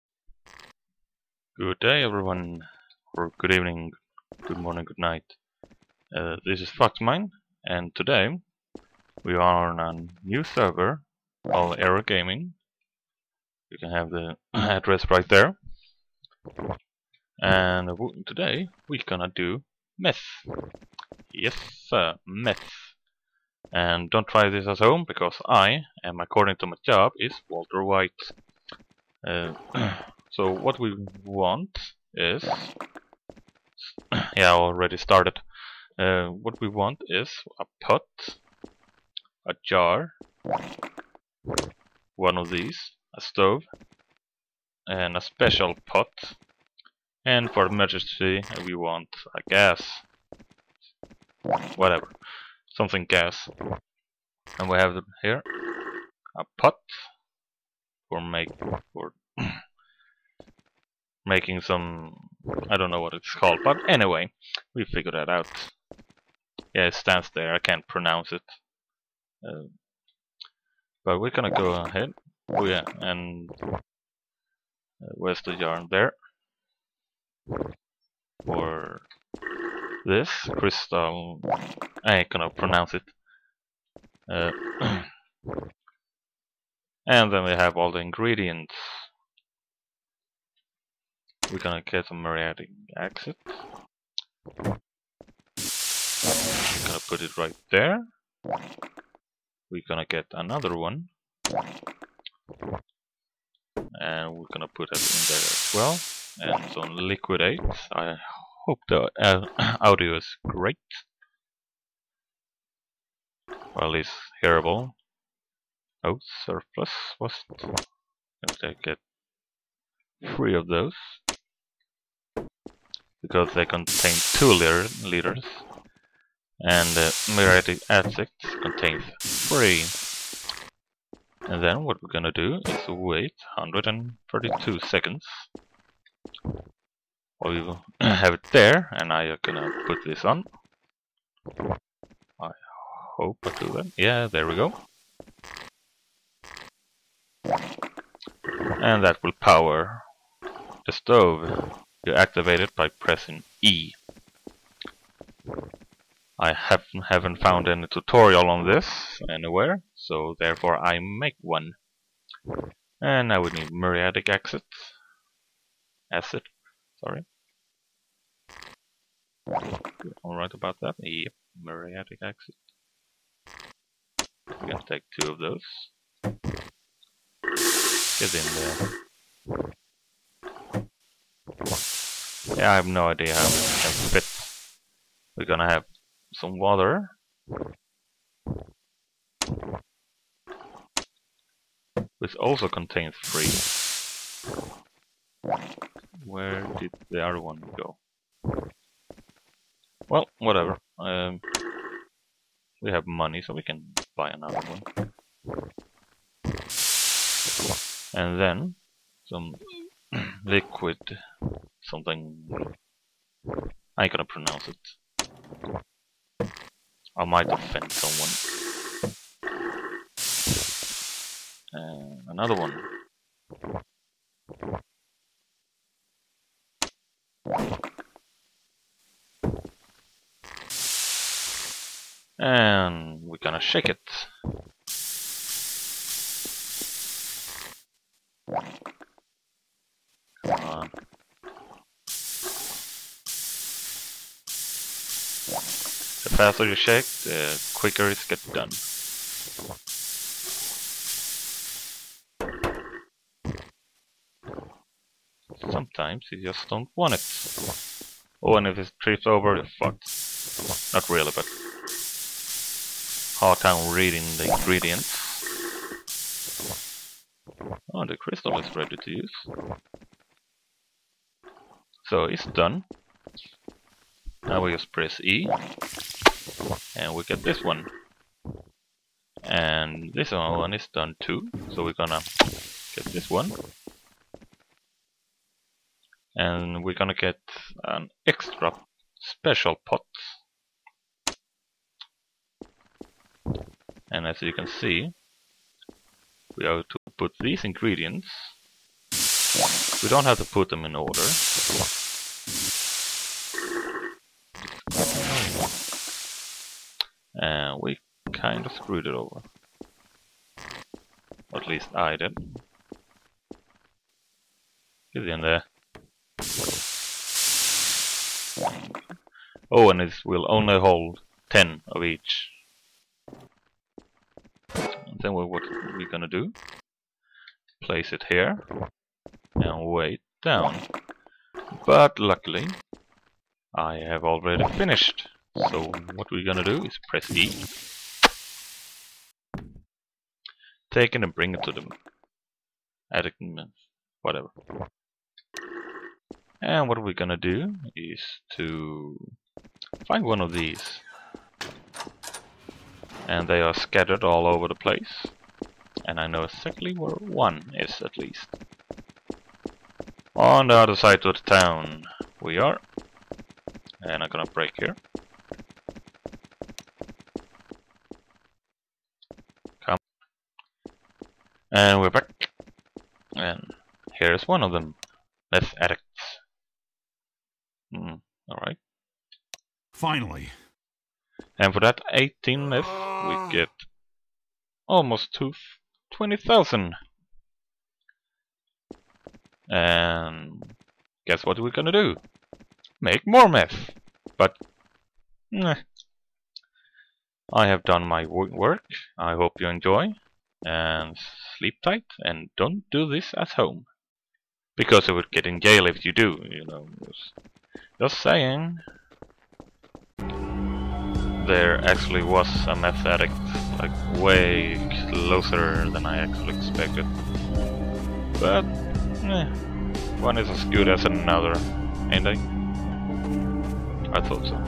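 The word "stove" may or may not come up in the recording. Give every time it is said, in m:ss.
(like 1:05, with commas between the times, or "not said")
0:43, 2:30.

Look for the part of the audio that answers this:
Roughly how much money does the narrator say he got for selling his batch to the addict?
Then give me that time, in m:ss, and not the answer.
6:24.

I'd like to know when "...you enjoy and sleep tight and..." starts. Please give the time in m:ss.
6:39.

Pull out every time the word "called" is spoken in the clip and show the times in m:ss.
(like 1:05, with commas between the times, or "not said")
0:11, 1:03.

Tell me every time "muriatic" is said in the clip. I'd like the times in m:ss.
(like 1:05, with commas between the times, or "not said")
2:07, 2:43, 2:51.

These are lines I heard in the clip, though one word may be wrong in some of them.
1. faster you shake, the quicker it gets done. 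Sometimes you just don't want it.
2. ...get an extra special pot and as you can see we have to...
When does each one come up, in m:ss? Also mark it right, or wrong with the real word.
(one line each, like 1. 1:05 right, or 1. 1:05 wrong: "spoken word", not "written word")
1. 4:06 right
2. 4:47 right.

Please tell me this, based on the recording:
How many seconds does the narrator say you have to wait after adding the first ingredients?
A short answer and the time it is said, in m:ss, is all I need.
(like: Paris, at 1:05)
132, at 2:13.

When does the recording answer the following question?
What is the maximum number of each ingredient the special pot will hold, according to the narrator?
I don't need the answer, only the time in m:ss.
5:21.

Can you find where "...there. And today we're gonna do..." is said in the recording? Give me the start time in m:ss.
0:15.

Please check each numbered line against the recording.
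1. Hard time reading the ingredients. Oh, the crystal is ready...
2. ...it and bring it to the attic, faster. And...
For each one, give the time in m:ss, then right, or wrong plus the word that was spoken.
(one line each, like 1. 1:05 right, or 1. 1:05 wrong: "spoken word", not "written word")
1. 4:23 right
2. 5:41 wrong: "whatever", not "faster".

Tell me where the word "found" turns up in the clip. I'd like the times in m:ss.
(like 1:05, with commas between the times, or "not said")
2:37.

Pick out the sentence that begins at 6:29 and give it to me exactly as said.
And guess what we're gonna do?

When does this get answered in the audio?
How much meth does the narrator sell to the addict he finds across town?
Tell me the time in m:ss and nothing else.
6:22.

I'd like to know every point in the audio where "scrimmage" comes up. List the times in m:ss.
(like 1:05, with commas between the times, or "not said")
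not said.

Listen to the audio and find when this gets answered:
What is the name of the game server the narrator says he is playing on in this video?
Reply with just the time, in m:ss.
0:11.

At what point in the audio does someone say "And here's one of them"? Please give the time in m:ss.
6:13.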